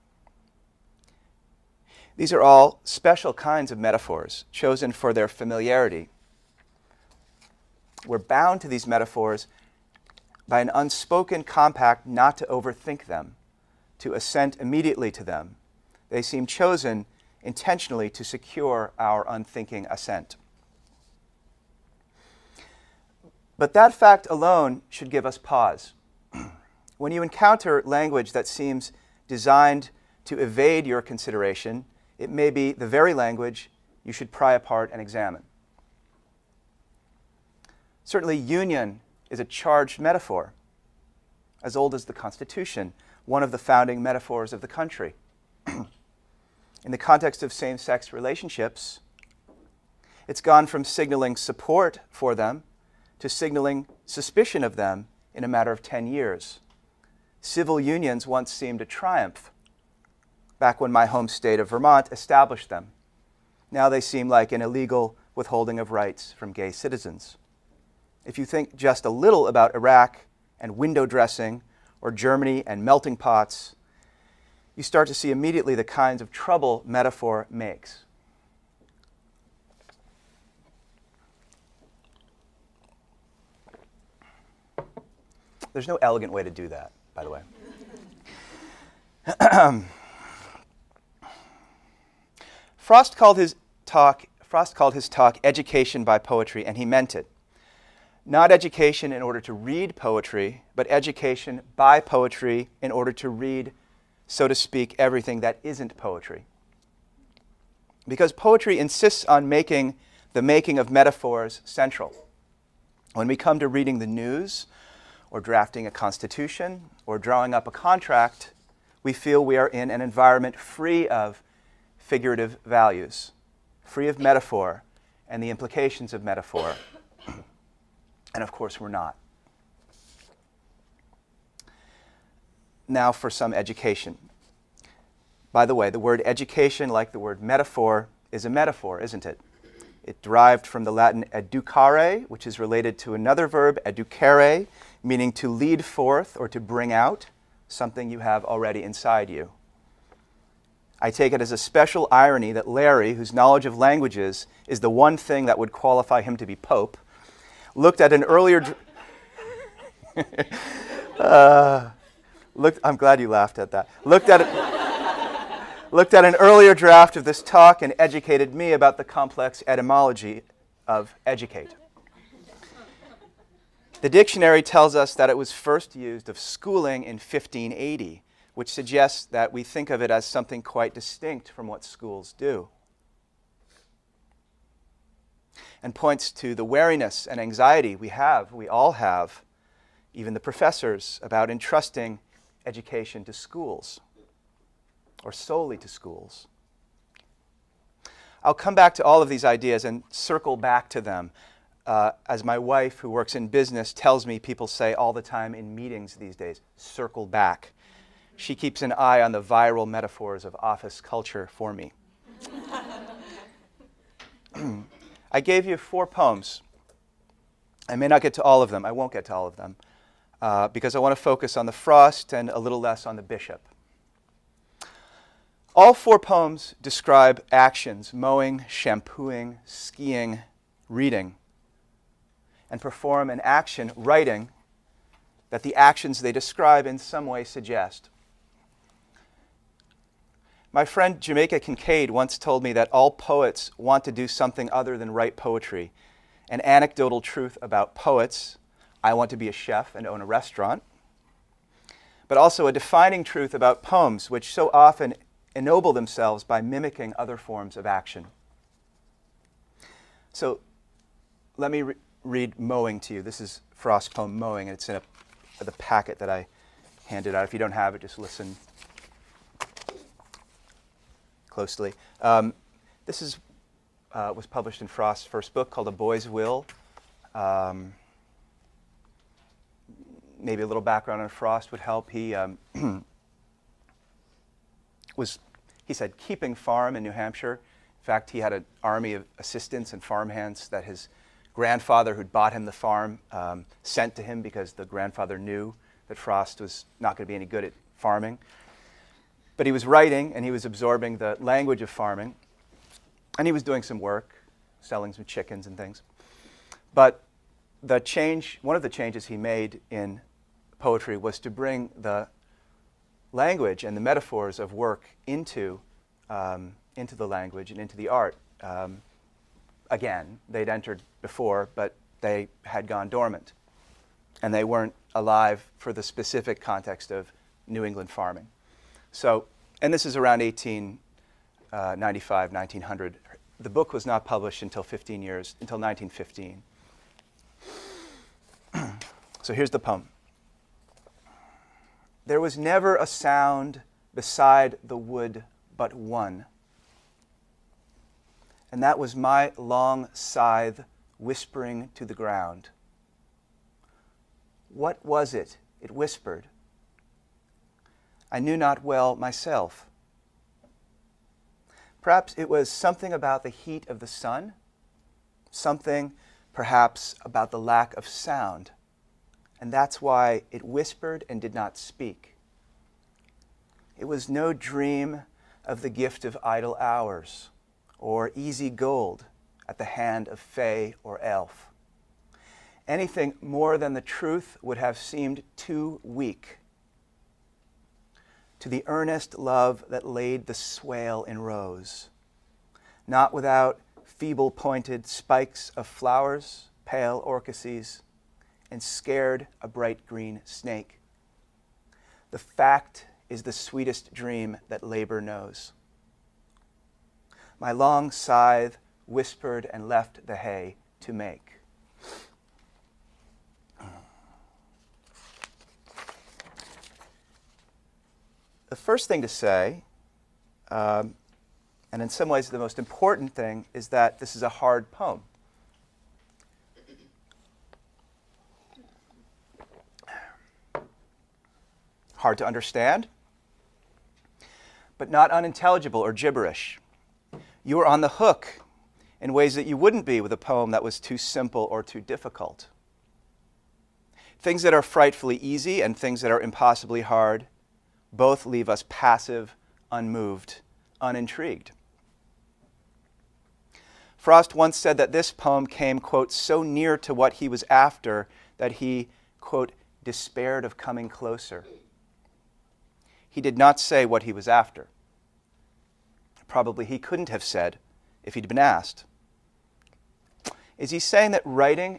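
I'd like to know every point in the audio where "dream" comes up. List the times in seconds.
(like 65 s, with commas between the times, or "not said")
374 s, 404 s.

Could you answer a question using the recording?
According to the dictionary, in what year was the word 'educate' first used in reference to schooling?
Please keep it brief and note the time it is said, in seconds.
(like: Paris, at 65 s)
1580, at 177 s.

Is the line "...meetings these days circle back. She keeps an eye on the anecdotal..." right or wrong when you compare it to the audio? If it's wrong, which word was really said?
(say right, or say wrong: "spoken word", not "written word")
wrong: "viral", not "anecdotal".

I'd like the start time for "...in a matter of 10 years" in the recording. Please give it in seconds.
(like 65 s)
55 s.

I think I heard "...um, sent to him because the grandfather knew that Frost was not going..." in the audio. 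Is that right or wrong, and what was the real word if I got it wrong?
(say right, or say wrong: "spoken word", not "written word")
right.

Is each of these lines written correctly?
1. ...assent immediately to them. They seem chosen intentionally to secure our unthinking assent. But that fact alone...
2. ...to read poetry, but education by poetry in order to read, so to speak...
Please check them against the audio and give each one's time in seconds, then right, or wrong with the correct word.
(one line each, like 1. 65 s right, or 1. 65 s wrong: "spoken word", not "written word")
1. 14 s right
2. 99 s right.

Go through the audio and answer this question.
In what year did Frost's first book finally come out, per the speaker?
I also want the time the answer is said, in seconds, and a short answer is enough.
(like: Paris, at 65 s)
1915, at 335 s.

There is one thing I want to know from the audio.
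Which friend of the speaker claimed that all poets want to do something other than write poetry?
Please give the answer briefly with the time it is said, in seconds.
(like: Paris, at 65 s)
Jamaica Kincaid, at 241 s.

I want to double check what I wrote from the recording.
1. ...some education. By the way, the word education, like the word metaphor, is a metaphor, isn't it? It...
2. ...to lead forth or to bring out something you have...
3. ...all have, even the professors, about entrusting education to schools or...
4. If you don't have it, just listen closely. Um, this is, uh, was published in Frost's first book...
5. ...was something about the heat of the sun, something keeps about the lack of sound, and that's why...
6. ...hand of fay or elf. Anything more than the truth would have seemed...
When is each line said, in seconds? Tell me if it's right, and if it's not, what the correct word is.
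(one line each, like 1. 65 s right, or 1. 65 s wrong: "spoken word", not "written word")
1. 133 s right
2. 145 s right
3. 188 s right
4. 267 s right
5. 362 s wrong: "perhaps", not "keeps"
6. 379 s right.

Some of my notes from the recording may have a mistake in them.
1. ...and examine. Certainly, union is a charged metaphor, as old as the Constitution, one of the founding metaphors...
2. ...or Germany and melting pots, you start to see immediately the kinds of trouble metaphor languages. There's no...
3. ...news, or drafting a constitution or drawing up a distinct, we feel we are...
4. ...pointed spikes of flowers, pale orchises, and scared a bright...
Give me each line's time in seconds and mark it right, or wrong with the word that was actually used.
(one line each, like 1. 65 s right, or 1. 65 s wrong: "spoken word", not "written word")
1. 34 s right
2. 72 s wrong: "makes", not "languages"
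3. 114 s wrong: "contract", not "distinct"
4. 394 s right.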